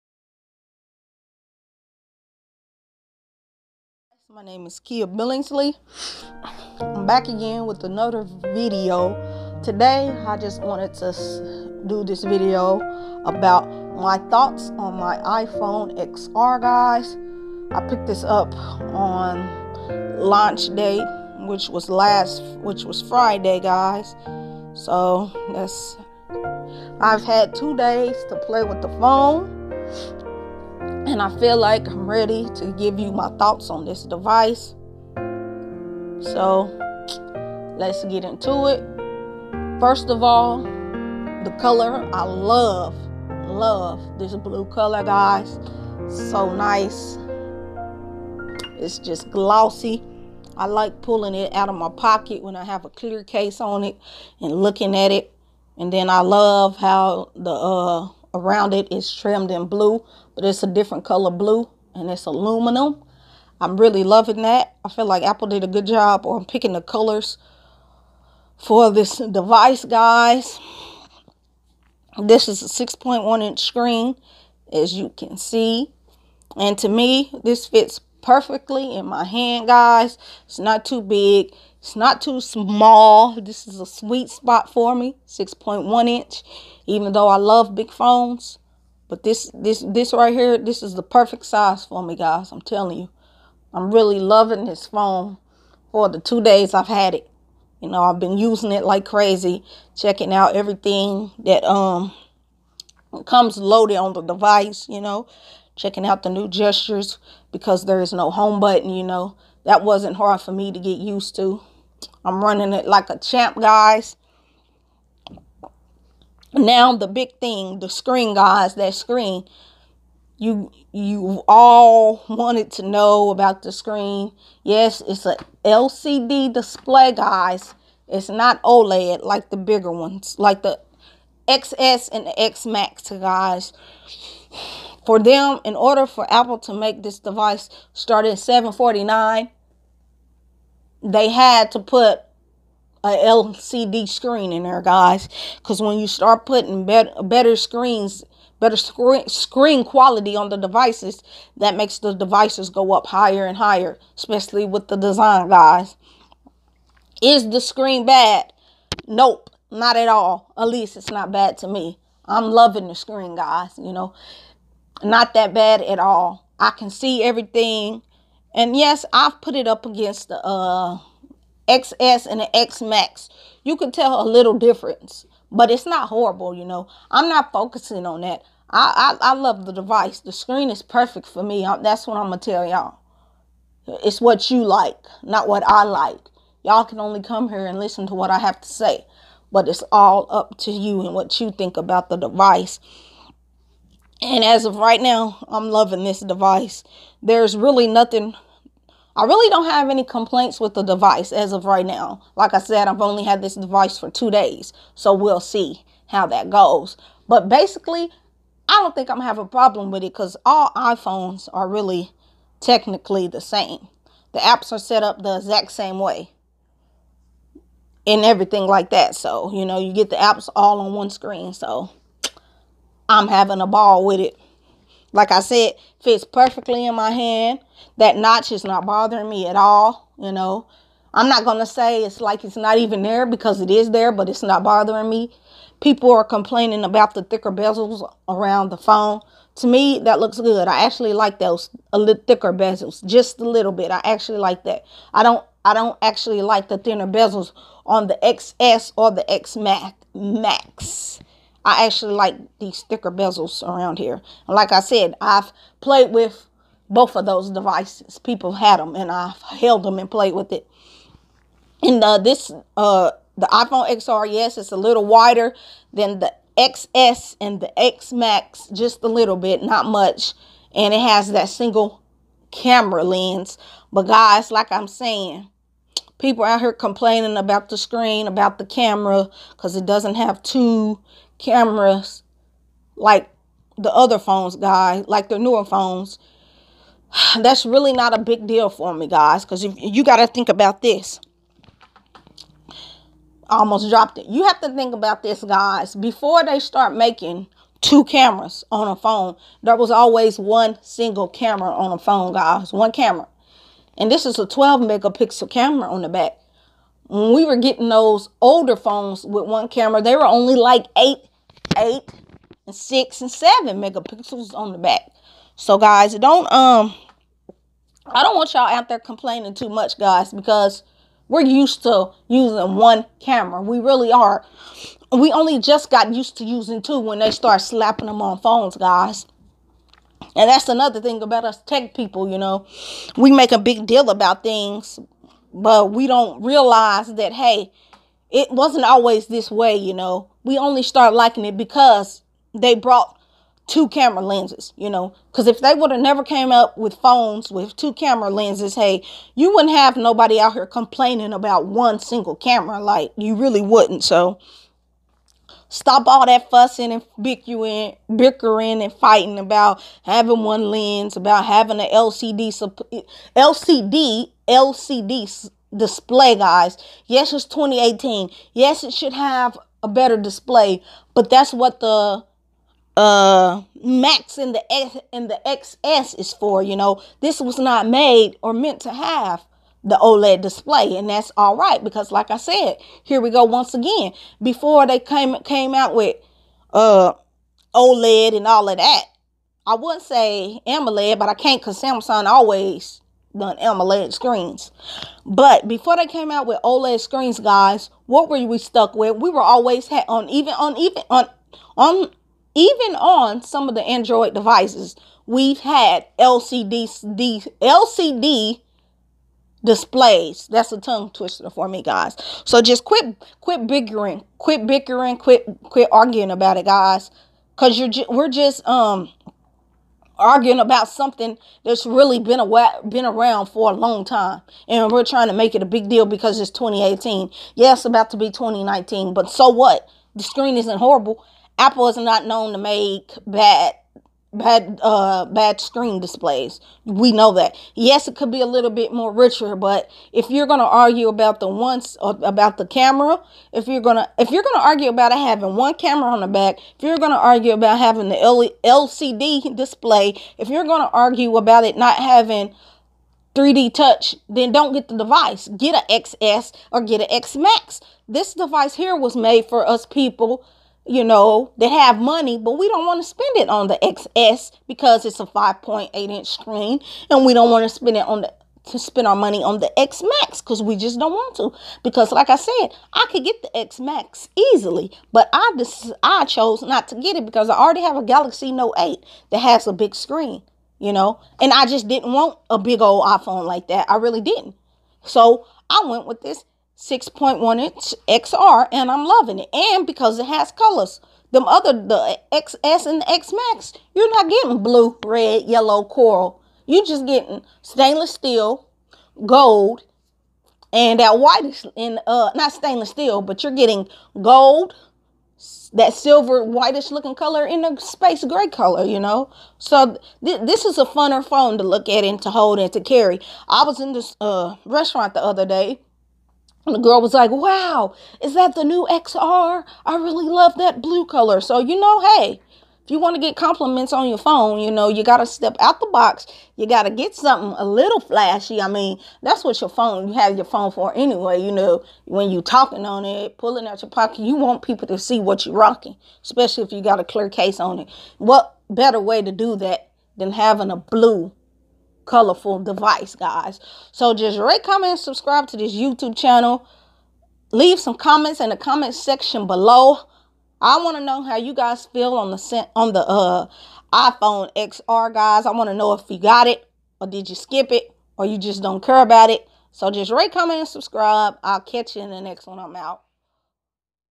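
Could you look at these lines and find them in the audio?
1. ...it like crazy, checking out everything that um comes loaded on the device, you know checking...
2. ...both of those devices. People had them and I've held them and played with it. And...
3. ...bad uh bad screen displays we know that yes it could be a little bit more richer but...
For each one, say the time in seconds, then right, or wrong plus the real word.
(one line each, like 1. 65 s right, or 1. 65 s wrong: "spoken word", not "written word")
1. 98 s right
2. 256 s right
3. 434 s right.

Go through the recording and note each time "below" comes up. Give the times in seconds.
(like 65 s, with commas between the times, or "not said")
549 s.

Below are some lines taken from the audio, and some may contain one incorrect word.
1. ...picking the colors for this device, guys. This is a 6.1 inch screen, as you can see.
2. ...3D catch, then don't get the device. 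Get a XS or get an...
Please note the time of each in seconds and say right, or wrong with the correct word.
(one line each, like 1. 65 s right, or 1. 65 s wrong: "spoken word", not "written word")
1. 66 s right
2. 453 s wrong: "touch", not "catch".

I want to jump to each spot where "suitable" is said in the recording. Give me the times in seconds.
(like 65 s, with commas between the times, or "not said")
not said.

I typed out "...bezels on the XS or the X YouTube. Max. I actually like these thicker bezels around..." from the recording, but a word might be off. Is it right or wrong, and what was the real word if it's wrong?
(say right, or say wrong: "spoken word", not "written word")
wrong: "Max", not "YouTube".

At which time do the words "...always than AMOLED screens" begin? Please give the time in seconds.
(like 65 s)
392 s.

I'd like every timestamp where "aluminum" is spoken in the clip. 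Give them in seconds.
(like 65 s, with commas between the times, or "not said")
62 s.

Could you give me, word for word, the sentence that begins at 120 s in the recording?
You you all wanted to know about the screen.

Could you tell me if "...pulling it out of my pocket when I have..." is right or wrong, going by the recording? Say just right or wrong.
right.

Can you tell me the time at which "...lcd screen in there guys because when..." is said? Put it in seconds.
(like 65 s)
143 s.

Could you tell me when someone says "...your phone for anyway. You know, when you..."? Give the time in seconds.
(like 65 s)
530 s.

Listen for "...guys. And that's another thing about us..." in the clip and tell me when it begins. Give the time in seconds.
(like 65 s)
328 s.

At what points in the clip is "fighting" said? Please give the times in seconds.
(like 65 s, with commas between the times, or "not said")
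358 s.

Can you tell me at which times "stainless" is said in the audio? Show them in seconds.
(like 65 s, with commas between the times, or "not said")
497 s, 502 s.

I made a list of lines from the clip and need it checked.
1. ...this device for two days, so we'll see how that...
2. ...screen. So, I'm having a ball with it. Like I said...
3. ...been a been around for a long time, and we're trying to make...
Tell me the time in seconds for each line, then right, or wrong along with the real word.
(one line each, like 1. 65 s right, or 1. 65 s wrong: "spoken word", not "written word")
1. 203 s right
2. 221 s right
3. 422 s right.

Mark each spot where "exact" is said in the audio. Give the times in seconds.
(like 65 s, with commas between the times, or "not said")
215 s.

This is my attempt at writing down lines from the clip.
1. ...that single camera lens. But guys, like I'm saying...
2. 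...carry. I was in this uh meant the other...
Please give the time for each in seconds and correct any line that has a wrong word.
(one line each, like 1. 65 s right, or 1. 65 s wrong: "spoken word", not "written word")
1. 271 s right
2. 512 s wrong: "restaurant", not "meant".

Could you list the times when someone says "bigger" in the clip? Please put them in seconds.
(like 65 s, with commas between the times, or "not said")
129 s.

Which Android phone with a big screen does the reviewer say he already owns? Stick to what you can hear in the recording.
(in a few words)
Galaxy Note 8.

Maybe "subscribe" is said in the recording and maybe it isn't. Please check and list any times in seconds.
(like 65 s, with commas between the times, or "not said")
544 s, 560 s.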